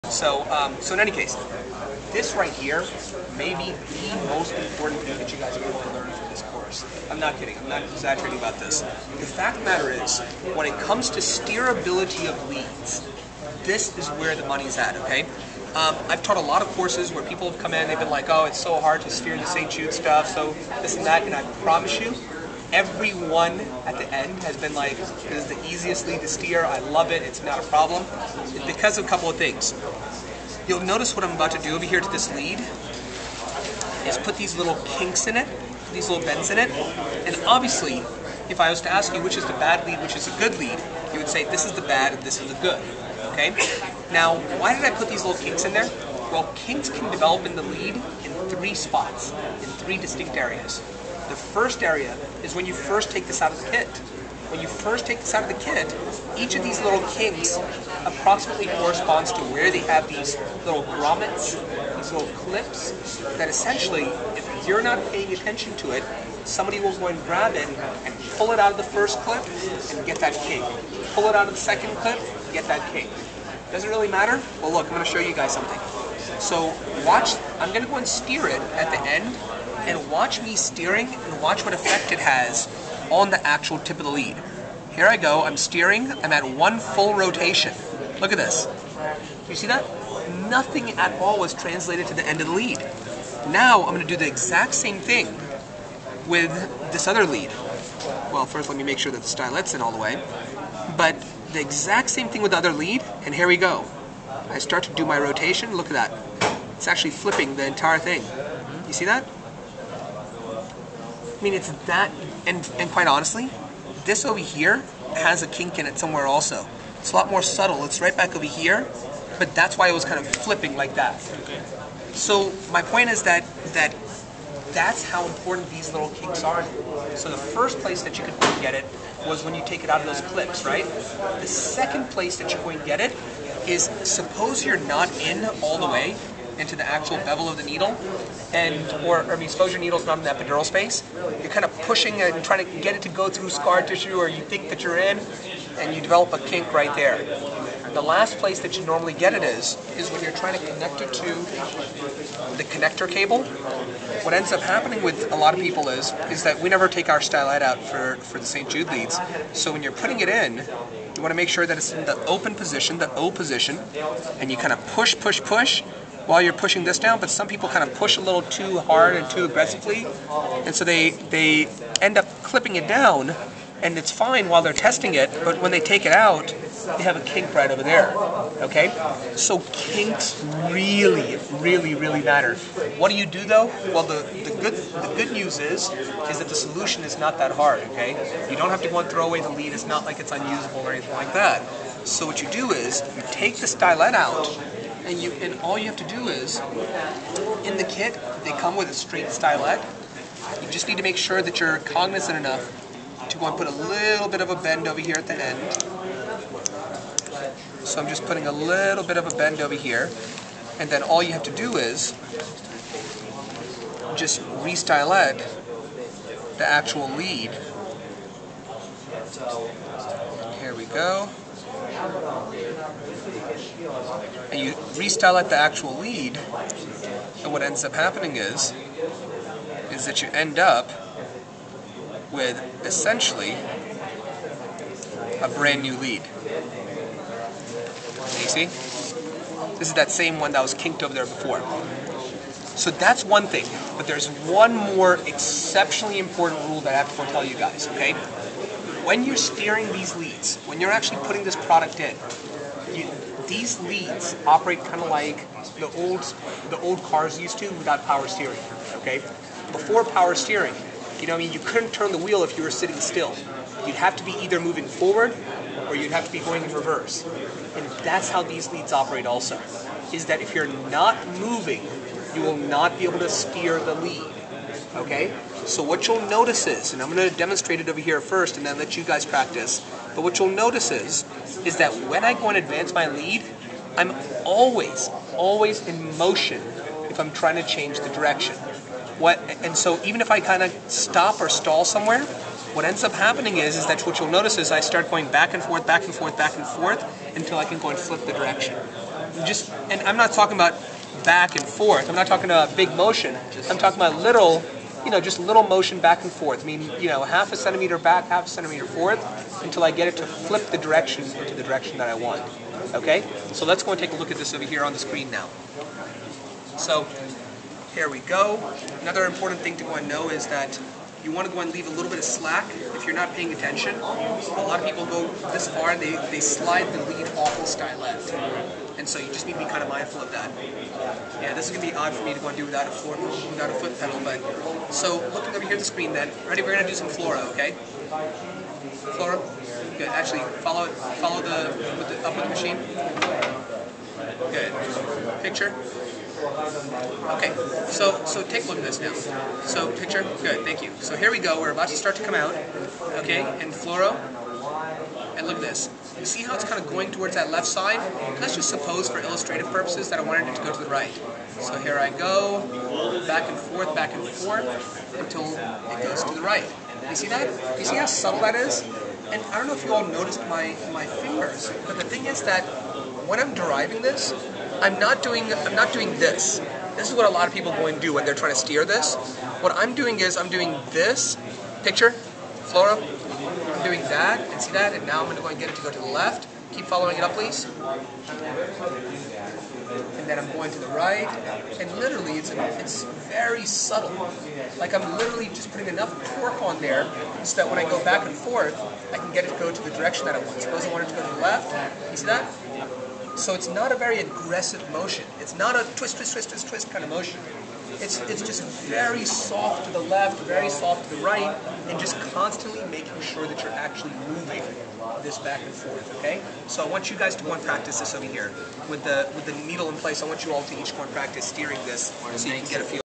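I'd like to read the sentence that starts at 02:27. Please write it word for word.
The last place that you normally get it is is when you're trying to connect it to the connector cable.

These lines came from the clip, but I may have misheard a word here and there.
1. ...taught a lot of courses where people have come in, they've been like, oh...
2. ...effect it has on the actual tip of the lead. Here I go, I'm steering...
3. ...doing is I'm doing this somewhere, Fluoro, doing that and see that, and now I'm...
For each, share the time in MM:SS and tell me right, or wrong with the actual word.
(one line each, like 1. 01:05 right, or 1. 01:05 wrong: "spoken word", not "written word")
1. 00:16 right
2. 01:21 right
3. 06:19 wrong: "picture", not "somewhere".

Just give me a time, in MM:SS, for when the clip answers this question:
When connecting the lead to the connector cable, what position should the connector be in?
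02:42.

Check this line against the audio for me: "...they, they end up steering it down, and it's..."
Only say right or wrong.
wrong.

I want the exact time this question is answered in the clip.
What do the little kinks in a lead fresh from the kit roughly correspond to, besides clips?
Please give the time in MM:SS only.
01:00.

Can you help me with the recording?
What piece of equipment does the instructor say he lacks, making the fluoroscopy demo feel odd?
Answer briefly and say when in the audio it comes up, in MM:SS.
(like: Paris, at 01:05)
foot pedal, at 05:33.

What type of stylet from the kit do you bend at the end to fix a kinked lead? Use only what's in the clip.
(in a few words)
straight stylet.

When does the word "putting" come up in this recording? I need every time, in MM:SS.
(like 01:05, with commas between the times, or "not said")
02:39, 03:28, 04:11, 06:35.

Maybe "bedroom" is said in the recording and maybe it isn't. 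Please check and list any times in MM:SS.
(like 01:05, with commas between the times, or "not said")
not said.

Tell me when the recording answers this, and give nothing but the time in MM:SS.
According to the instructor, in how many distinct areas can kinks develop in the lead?
00:49.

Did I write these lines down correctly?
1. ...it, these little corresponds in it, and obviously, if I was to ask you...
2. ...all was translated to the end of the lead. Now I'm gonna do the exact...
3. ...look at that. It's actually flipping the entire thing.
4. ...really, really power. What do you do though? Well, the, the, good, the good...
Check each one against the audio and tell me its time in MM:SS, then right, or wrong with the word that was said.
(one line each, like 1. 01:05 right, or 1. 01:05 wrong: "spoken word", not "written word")
1. 00:35 wrong: "bends", not "corresponds"
2. 01:31 right
3. 01:45 right
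4. 03:01 wrong: "matter", not "power".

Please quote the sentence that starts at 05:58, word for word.
Let's just suppose for illustrative purposes that I wanted it to go to the right.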